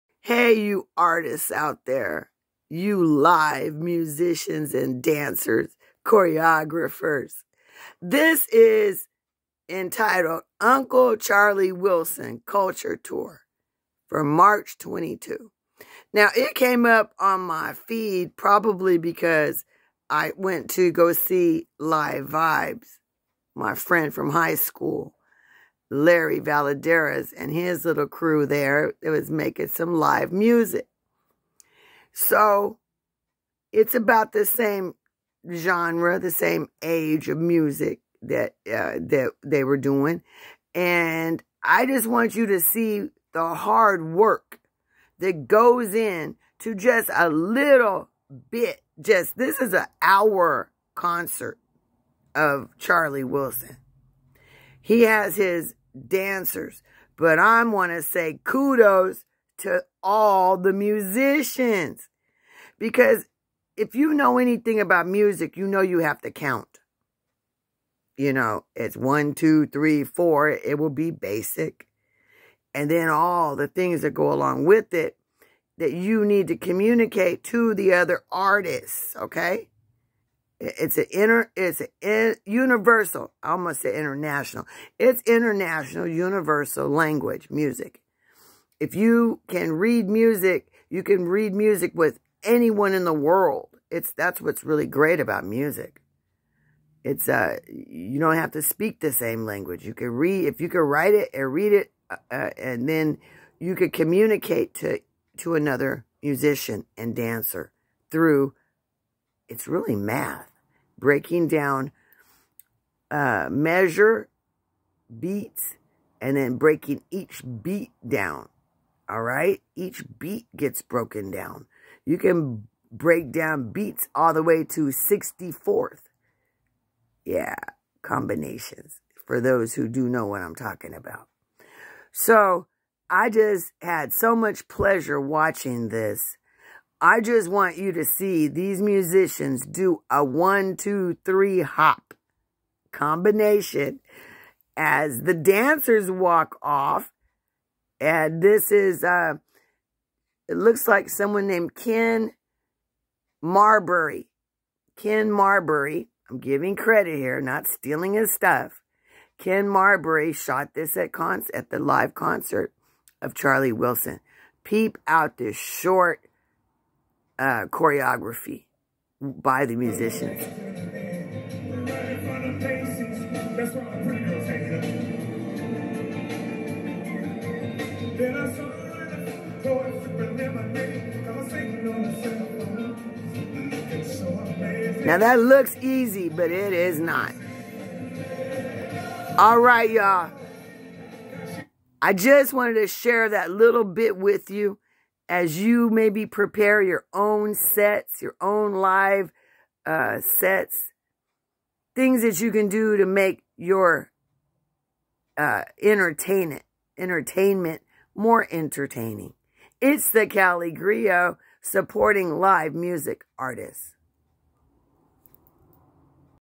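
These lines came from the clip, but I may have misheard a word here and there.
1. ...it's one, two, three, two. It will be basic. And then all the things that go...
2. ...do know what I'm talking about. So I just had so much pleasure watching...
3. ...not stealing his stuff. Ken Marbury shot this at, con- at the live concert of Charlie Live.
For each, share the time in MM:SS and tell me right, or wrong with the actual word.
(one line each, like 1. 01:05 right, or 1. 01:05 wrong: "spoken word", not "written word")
1. 01:08 wrong: "four", not "two"
2. 02:09 right
3. 02:37 wrong: "Wilson", not "Live".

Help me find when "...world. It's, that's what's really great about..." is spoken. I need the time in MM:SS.
01:33.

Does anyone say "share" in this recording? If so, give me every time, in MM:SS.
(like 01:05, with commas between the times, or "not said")
03:12.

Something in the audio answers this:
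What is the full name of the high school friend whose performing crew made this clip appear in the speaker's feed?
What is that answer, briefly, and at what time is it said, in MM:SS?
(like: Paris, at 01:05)
Larry Valadares, at 00:25.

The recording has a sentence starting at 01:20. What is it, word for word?
It's an inter, it's an universal, I almost say international.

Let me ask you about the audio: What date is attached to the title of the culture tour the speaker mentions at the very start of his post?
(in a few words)
March 22.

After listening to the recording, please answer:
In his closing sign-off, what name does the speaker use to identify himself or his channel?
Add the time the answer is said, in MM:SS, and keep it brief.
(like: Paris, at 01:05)
CaliGriot, at 03:30.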